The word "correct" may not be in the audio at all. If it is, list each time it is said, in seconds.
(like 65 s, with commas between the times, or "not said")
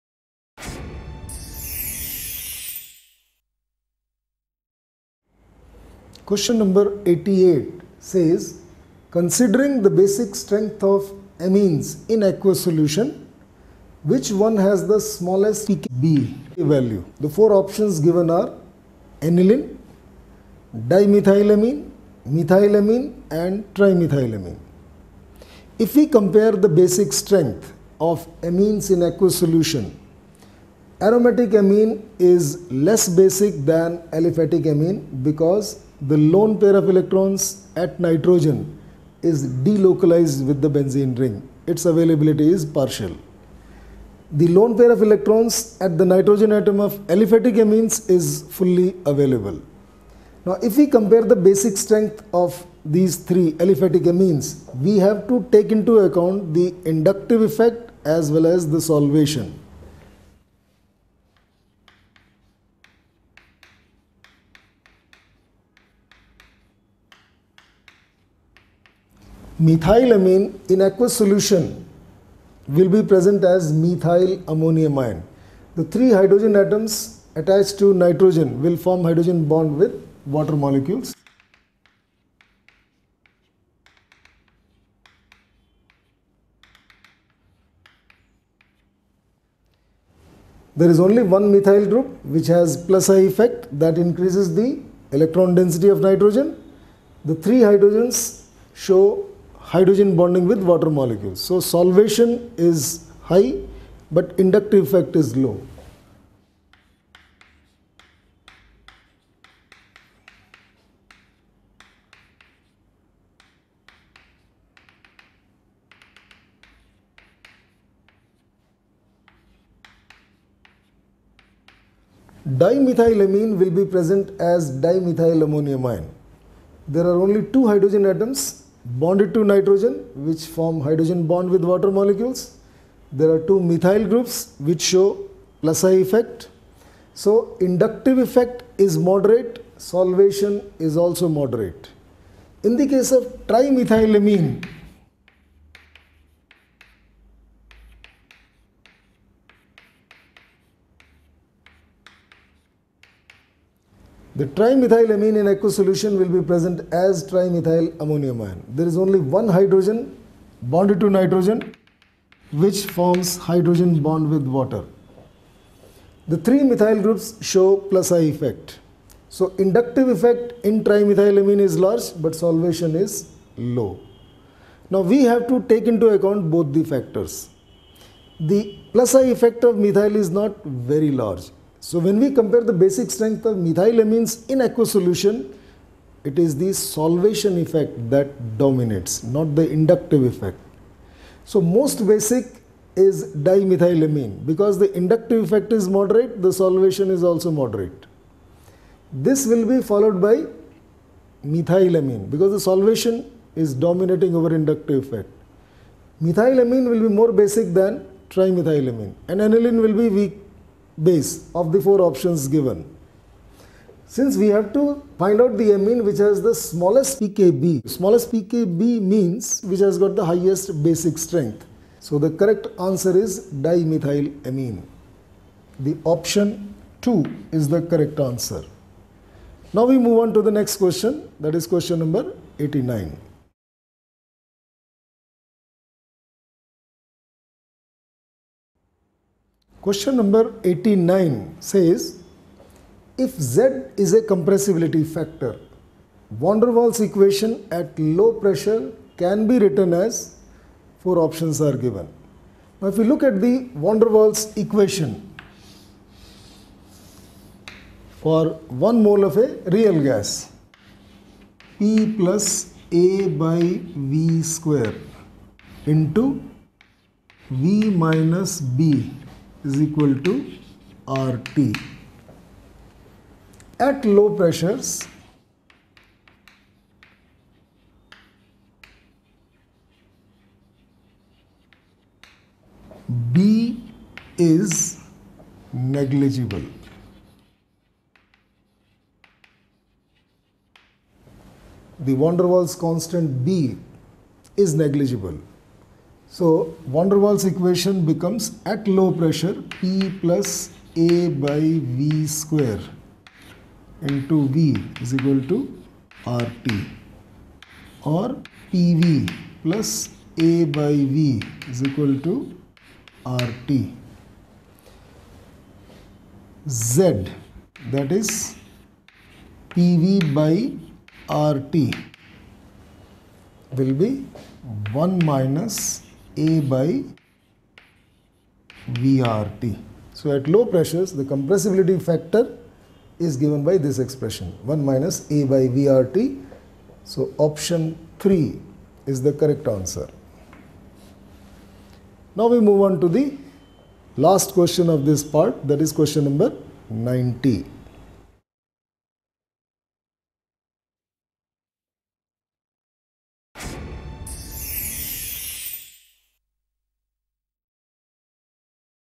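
222 s, 227 s, 339 s.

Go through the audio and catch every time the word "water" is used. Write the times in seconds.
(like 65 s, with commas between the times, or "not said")
80 s, 100 s, 131 s, 164 s.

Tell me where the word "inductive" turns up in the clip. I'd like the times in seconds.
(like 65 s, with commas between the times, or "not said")
56 s, 104 s, 137 s, 169 s, 189 s, 194 s, 204 s.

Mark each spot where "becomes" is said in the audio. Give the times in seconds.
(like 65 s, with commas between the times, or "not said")
298 s.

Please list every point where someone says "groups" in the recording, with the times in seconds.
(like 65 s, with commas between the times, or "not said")
91 s, 134 s, 167 s.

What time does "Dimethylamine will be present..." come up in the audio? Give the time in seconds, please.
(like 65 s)
122 s.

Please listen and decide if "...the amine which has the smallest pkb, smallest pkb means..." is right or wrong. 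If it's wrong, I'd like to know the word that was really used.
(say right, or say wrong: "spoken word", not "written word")
right.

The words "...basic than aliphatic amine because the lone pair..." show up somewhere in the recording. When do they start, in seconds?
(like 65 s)
33 s.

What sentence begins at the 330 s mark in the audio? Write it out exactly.
So at low pressures, the compressibility factor is given by this expression 1 minus A by VRT.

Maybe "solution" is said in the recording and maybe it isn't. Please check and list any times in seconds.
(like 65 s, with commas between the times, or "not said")
12 s, 29 s, 71 s, 155 s, 184 s.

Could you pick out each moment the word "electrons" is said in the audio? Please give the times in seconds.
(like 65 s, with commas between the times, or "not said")
36 s, 45 s, 95 s.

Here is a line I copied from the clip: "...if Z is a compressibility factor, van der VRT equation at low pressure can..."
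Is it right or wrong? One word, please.
wrong.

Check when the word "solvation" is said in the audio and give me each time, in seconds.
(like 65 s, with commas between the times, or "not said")
58 s, 101 s, 139 s, 172 s, 186 s, 196 s, 202 s.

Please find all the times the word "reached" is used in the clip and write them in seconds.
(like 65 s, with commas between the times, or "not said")
not said.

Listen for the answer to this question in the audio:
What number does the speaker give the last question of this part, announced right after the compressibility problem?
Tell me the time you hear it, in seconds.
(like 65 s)
346 s.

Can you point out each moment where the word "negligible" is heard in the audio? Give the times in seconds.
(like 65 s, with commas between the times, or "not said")
285 s, 294 s.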